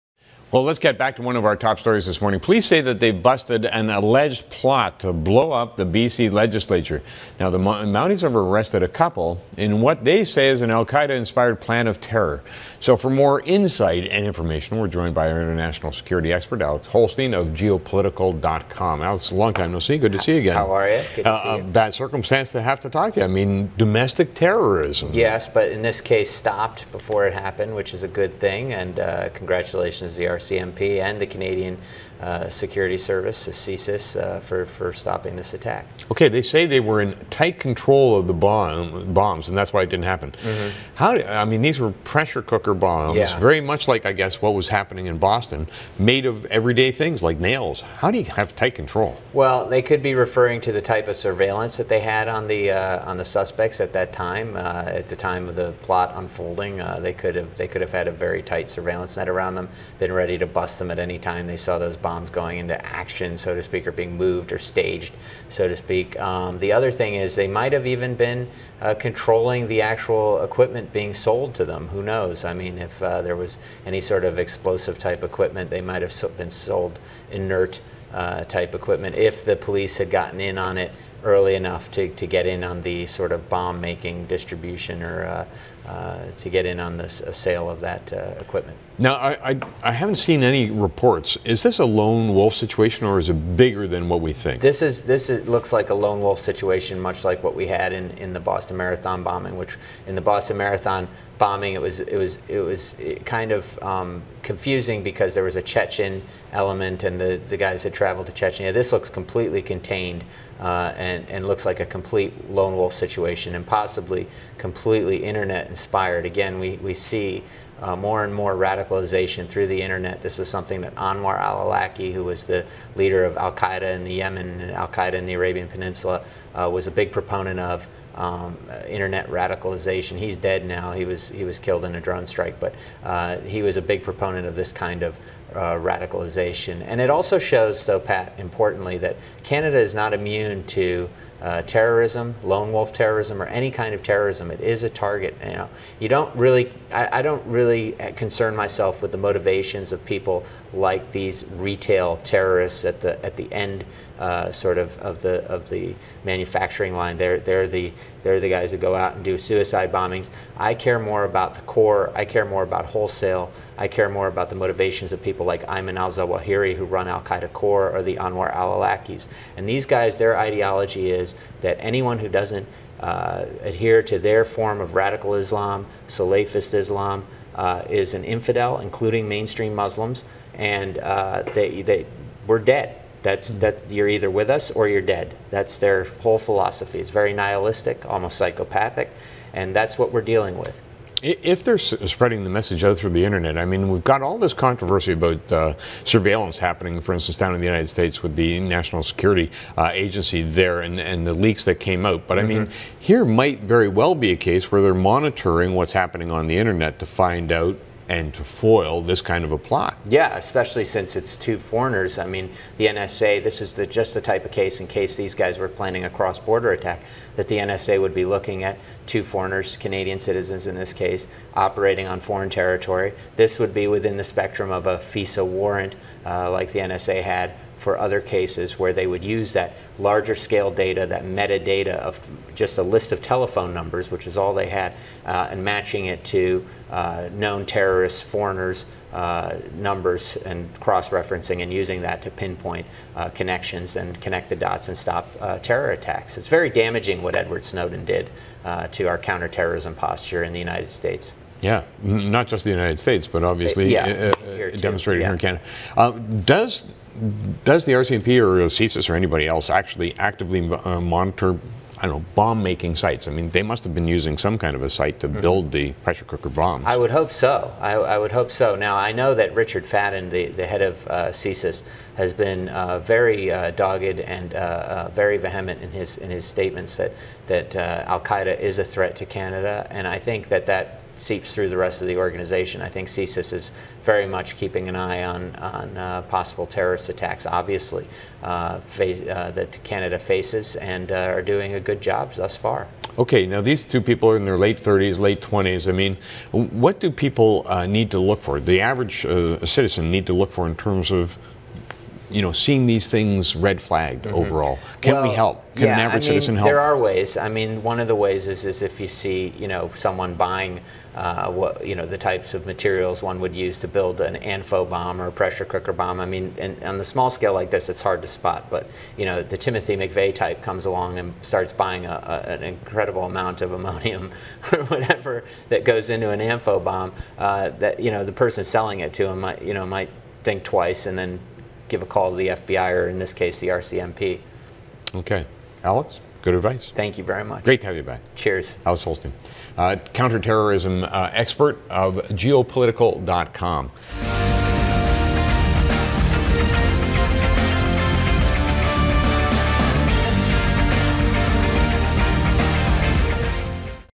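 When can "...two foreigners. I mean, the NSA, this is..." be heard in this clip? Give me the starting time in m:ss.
3:31.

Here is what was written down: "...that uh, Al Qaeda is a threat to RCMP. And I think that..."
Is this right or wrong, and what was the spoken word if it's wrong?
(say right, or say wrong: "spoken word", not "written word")
wrong: "Canada", not "RCMP".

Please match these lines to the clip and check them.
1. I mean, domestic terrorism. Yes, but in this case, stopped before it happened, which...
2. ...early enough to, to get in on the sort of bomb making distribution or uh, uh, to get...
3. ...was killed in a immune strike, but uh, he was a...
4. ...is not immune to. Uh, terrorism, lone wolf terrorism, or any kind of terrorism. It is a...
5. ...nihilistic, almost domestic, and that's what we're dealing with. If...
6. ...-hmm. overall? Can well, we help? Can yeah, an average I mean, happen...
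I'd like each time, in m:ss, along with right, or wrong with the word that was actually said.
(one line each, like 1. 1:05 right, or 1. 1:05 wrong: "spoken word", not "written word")
1. 0:23 right
2. 1:21 right
3. 2:11 wrong: "drone", not "immune"
4. 2:19 right
5. 3:07 wrong: "psychopathic", not "domestic"
6. 5:04 wrong: "citizen", not "happen".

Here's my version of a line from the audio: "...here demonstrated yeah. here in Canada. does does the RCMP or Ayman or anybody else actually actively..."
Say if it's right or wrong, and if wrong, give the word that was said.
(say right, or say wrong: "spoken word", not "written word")
wrong: "CSIS", not "Ayman".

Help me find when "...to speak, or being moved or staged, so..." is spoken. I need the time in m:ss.
1:03.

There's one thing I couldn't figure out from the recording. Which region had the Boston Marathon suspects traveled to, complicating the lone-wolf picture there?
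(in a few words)
Chechnya.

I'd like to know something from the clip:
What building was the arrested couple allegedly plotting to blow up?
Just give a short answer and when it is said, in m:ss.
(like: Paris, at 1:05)
BC legislature, at 0:05.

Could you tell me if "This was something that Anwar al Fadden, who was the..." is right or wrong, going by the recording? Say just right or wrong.
wrong.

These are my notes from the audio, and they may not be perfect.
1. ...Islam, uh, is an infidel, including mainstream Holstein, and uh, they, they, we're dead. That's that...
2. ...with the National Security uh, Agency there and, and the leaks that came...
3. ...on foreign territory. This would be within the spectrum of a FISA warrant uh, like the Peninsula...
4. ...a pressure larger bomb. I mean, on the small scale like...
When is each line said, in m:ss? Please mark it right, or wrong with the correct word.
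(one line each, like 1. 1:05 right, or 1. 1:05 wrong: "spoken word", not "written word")
1. 2:56 wrong: "Muslims", not "Holstein"
2. 3:18 right
3. 3:42 wrong: "NSA", not "Peninsula"
4. 5:15 wrong: "cooker", not "larger".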